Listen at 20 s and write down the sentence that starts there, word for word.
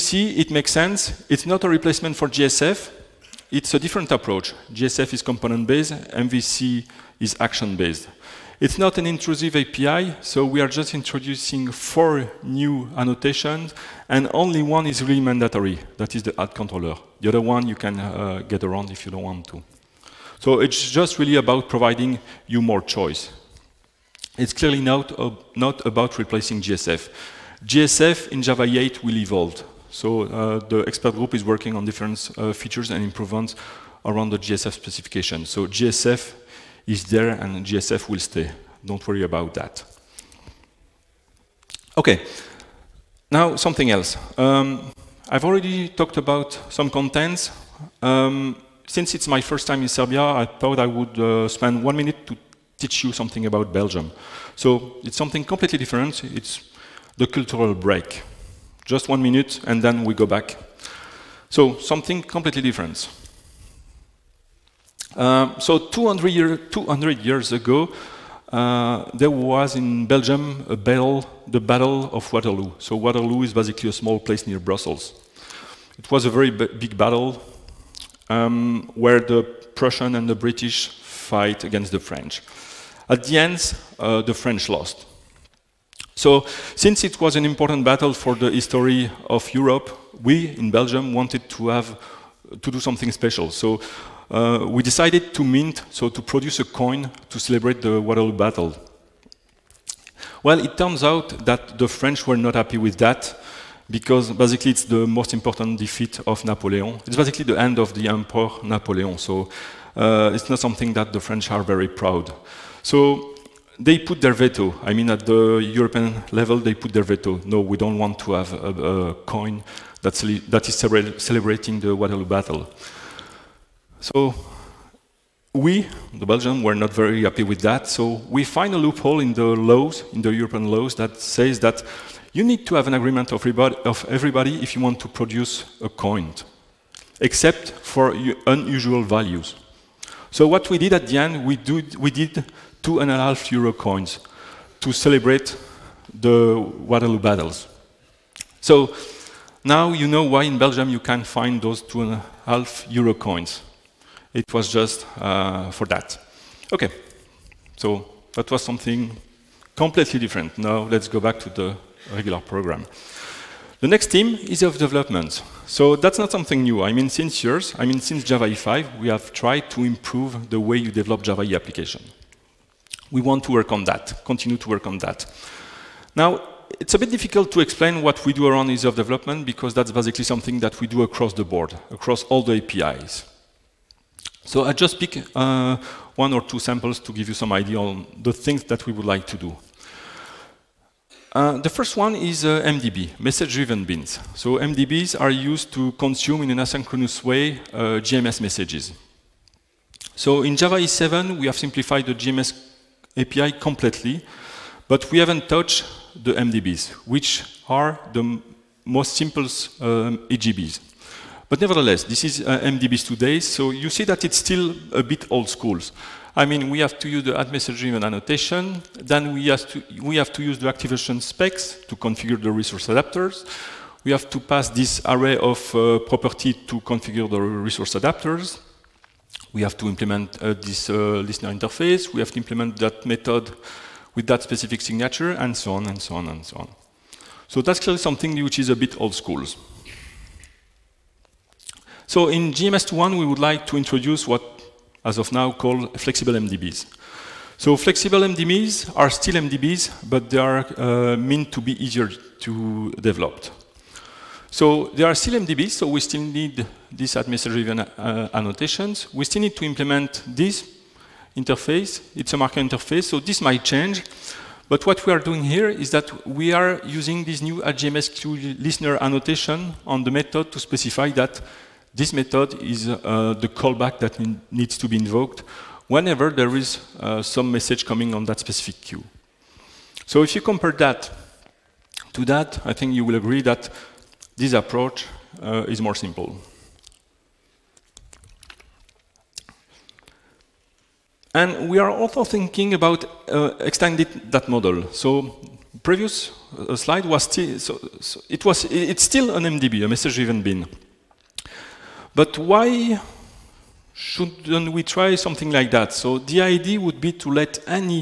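So it's just really about providing you more choice.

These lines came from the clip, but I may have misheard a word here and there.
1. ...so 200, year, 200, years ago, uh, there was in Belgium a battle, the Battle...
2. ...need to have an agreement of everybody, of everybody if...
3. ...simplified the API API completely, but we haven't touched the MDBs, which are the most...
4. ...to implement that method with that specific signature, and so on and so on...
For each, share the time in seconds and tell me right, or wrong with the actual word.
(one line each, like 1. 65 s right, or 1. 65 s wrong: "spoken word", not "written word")
1. 65 s right
2. 132 s right
3. 201 s wrong: "JMS", not "API"
4. 232 s right.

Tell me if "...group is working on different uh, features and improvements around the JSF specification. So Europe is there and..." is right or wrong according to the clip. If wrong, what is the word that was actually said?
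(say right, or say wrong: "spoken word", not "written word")
wrong: "JSF", not "Europe".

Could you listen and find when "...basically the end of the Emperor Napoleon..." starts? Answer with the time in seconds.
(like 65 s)
107 s.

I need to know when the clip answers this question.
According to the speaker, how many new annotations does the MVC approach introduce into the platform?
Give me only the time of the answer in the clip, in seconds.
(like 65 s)
11 s.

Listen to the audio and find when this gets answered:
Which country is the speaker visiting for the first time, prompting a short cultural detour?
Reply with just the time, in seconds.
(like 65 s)
49 s.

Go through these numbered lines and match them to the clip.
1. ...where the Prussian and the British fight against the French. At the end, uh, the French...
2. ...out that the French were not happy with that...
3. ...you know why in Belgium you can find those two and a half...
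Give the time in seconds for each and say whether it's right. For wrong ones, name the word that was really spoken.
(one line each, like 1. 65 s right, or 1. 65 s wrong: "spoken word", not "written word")
1. 78 s right
2. 101 s right
3. 149 s right.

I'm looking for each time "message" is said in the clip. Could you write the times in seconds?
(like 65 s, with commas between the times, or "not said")
193 s, 198 s, 217 s, 277 s, 299 s.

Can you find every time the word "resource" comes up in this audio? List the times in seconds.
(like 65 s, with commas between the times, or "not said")
222 s, 227 s.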